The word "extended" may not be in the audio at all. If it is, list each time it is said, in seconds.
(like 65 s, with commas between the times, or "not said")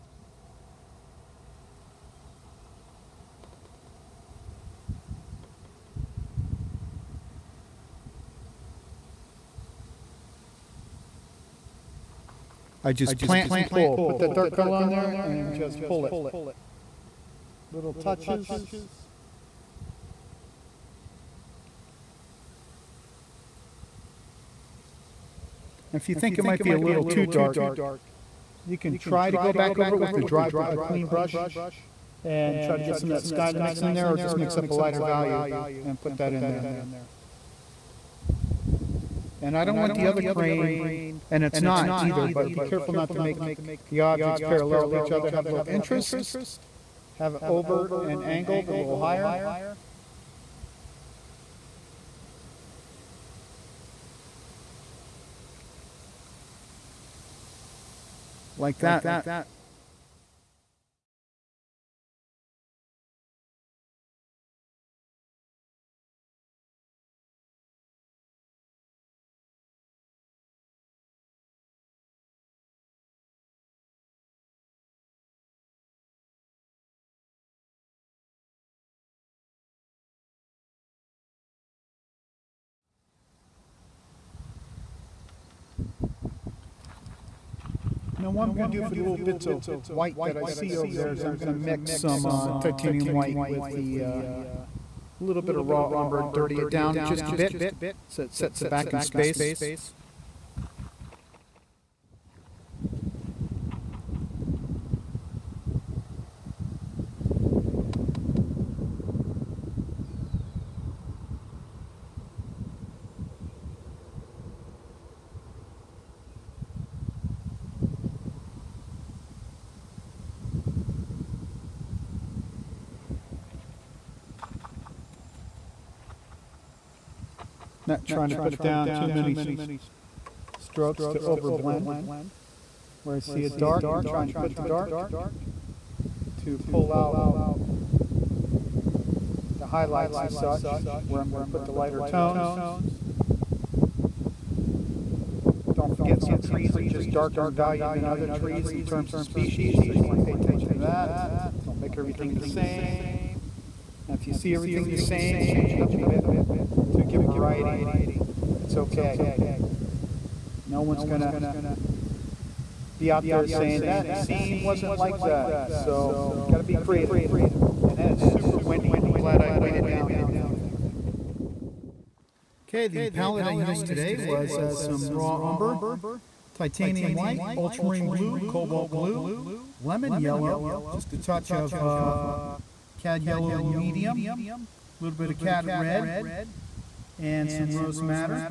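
not said.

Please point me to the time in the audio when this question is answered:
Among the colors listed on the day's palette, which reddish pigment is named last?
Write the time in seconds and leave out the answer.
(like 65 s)
187 s.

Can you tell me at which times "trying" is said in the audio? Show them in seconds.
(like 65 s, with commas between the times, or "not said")
128 s, 134 s.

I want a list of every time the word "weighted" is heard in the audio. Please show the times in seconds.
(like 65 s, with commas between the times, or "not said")
169 s.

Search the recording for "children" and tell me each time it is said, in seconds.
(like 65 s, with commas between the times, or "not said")
not said.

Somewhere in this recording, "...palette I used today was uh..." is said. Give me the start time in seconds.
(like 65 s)
173 s.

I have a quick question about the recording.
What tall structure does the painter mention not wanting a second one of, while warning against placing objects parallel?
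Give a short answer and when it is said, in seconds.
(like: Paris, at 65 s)
Crane, at 40 s.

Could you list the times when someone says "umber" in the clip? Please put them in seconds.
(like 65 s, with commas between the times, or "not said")
95 s, 175 s.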